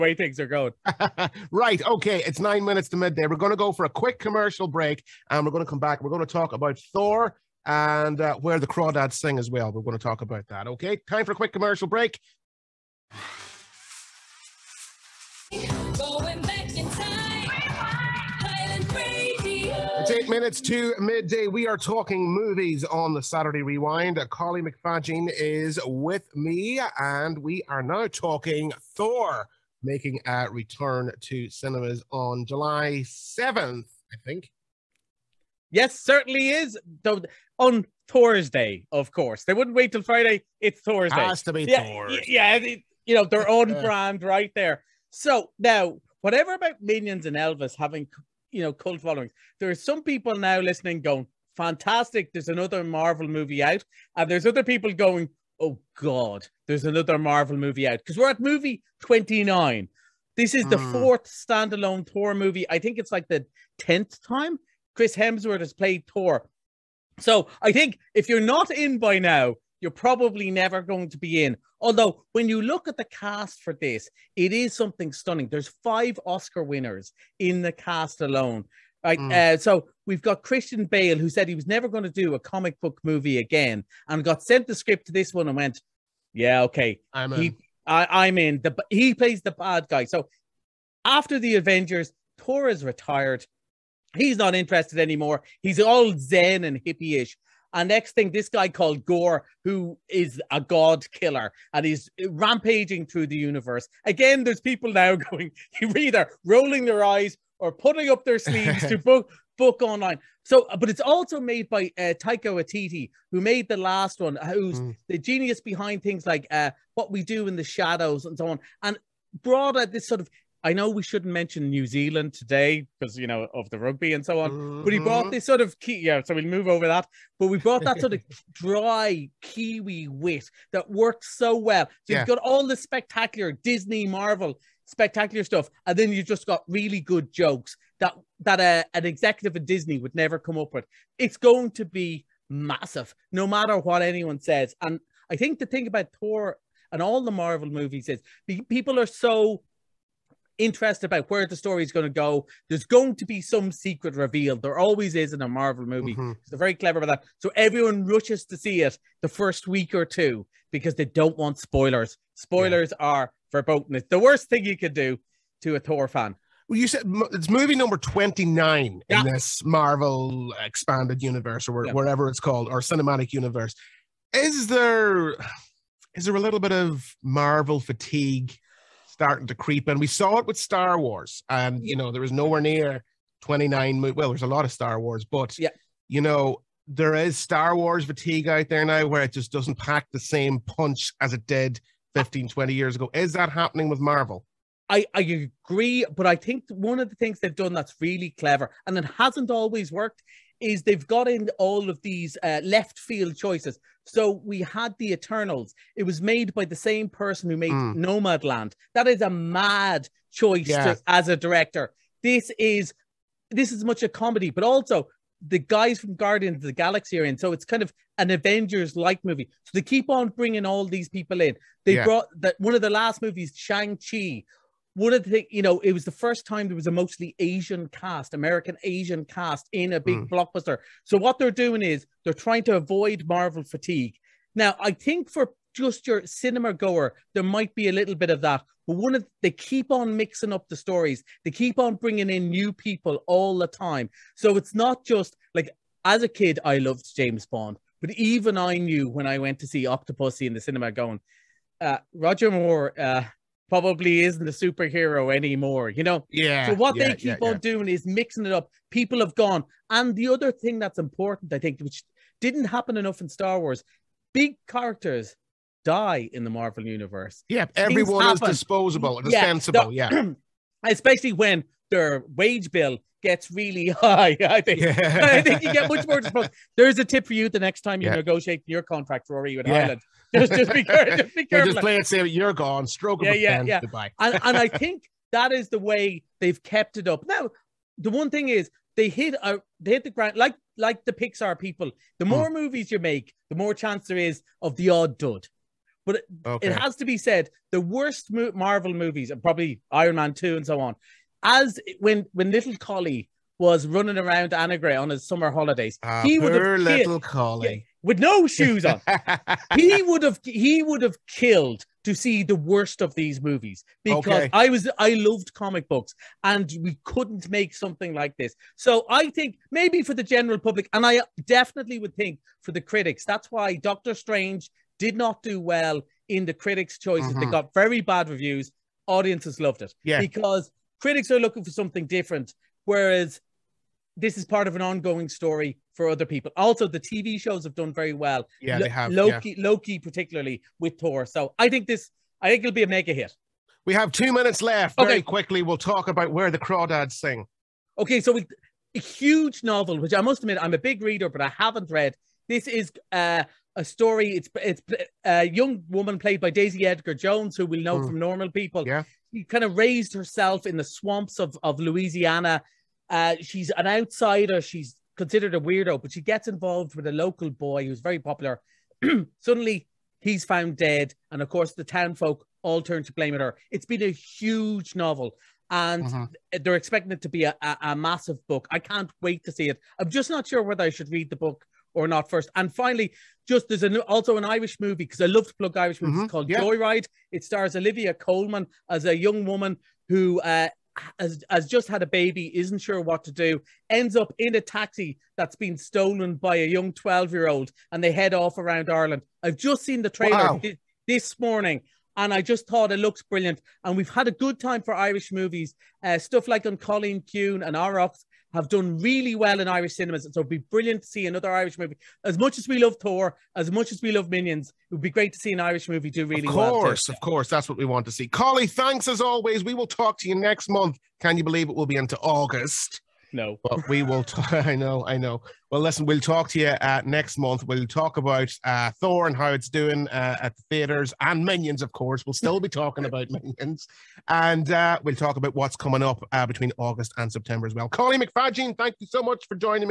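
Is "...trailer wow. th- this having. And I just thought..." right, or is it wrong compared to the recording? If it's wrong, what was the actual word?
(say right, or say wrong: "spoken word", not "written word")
wrong: "morning", not "having".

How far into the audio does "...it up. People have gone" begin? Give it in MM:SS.
04:18.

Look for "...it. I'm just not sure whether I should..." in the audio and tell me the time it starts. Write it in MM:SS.
06:19.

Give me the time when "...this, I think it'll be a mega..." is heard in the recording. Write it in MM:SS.
05:41.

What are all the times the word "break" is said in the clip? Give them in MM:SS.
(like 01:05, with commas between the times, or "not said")
00:04, 00:11.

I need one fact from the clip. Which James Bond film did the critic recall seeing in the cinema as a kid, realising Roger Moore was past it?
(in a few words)
Octopussy.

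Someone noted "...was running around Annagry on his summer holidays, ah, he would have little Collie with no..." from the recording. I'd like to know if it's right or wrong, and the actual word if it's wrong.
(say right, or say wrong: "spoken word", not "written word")
right.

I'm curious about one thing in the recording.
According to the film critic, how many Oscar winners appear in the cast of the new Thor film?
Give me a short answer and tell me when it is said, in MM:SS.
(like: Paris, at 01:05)
5, at 01:15.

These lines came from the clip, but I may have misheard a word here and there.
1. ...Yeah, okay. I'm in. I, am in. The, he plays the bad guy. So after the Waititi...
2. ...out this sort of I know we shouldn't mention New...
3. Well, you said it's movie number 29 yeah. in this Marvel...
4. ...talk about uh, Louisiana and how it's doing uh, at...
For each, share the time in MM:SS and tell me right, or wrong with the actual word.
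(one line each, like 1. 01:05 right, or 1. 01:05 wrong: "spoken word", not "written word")
1. 01:26 wrong: "Avengers", not "Waititi"
2. 01:59 right
3. 02:46 right
4. 07:07 wrong: "Thor", not "Louisiana".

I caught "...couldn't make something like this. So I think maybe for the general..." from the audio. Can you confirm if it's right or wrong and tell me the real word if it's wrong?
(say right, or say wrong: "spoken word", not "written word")
right.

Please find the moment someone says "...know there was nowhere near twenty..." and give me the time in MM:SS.
03:01.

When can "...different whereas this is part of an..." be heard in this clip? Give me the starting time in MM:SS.
05:32.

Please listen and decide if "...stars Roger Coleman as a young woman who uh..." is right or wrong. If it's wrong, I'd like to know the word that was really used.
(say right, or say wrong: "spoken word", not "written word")
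wrong: "Olivia", not "Roger".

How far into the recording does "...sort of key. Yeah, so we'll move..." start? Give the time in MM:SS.
02:05.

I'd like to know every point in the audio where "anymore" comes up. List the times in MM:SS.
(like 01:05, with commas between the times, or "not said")
01:34, 04:15.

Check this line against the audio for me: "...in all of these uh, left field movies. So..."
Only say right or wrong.
wrong.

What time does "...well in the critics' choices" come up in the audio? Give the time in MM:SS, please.
05:25.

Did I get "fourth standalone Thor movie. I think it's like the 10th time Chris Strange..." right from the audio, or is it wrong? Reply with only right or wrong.
wrong.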